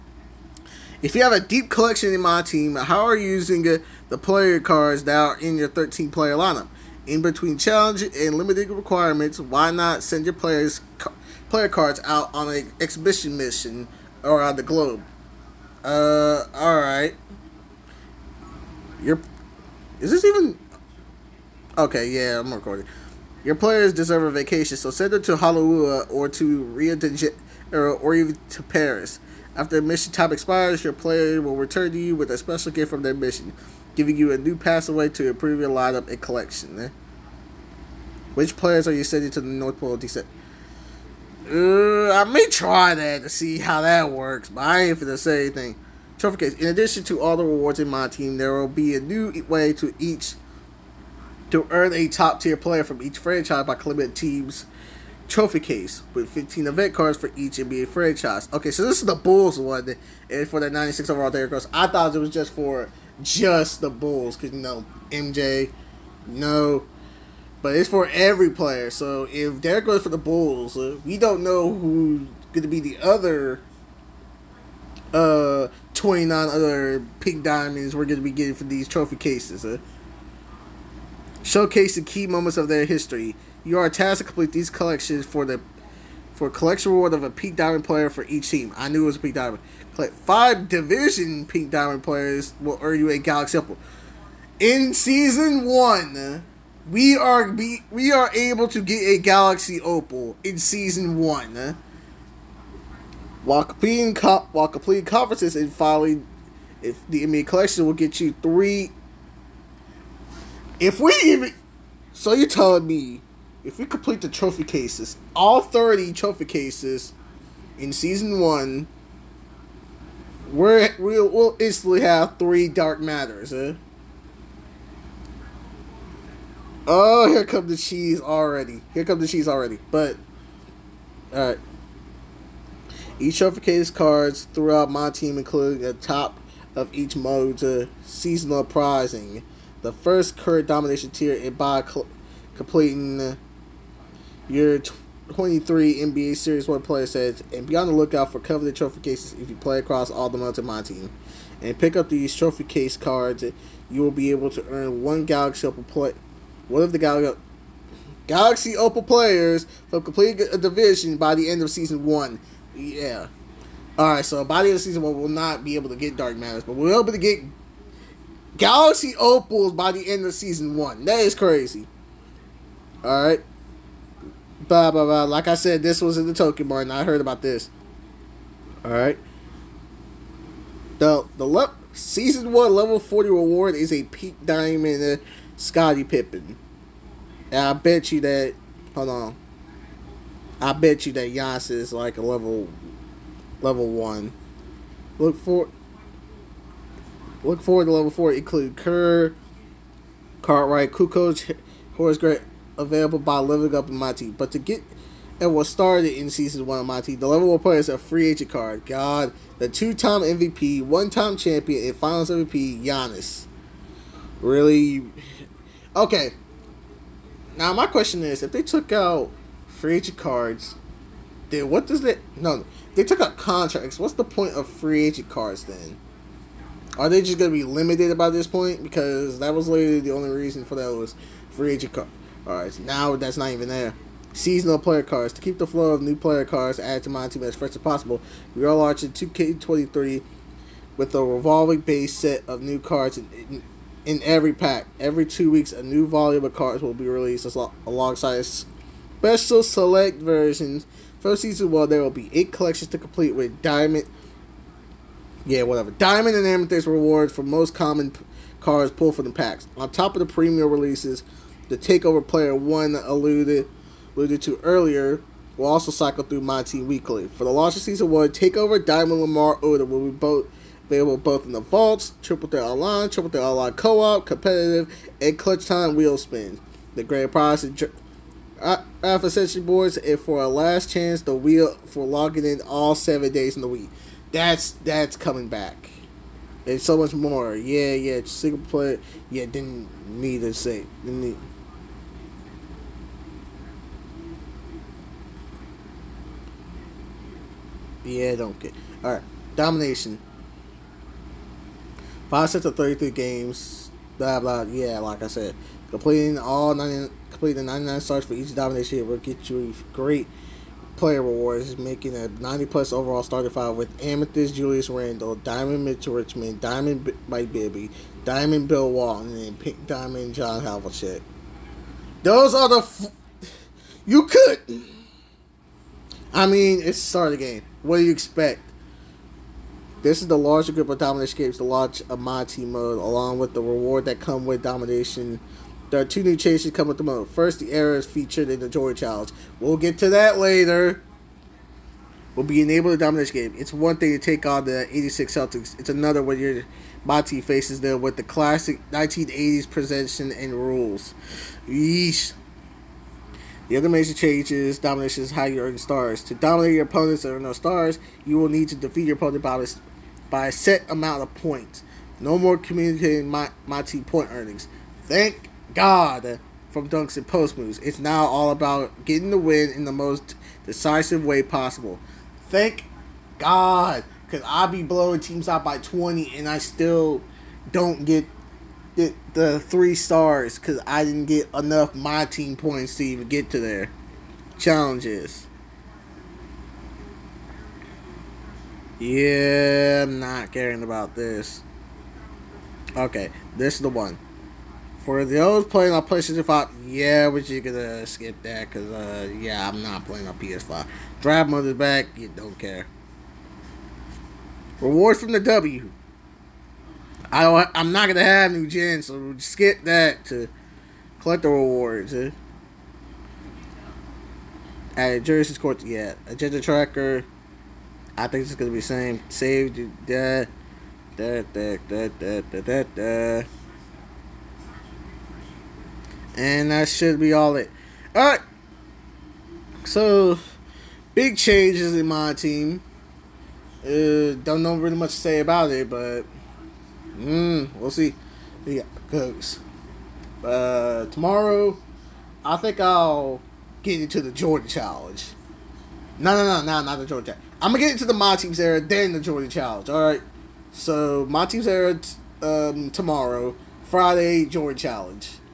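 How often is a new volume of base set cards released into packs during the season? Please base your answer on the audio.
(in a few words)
Every two weeks.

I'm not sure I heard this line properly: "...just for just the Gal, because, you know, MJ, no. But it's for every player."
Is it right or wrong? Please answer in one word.
wrong.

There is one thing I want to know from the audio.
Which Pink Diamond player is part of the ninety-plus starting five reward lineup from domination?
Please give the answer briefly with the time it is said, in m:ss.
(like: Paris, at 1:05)
John Havlicek, at 5:20.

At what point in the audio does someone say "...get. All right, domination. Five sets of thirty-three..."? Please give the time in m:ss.
4:58.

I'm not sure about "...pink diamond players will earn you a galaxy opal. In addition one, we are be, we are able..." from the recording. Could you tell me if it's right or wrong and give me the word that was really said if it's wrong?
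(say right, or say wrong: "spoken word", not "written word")
wrong: "season", not "addition".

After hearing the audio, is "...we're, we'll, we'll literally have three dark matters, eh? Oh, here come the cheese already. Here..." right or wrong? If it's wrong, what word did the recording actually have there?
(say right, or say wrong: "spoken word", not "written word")
wrong: "instantly", not "literally".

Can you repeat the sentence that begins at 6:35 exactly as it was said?
For those playing on PlayStation 5, yeah, but you gonna skip that because, uh, yeah, I'm not playing on PS5.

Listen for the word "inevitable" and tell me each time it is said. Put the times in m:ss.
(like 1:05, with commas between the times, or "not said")
not said.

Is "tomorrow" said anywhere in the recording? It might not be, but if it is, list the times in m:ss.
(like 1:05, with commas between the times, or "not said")
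7:21, 7:32.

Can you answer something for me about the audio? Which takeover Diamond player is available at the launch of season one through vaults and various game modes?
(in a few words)
Lamar Odom.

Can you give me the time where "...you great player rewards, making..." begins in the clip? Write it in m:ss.
5:09.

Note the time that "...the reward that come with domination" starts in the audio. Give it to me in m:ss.
5:33.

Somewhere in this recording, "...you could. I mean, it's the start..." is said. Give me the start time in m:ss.
5:24.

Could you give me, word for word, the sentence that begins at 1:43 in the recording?
While completing co- while completing conferences and filing, if the NBA collection will get you three.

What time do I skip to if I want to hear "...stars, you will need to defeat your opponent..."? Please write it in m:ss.
5:57.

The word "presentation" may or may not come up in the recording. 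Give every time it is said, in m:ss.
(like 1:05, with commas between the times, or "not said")
5:49.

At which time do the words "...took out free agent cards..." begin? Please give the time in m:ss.
3:38.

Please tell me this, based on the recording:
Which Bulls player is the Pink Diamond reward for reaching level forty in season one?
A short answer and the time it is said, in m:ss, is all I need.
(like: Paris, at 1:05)
Scottie Pippen, at 3:05.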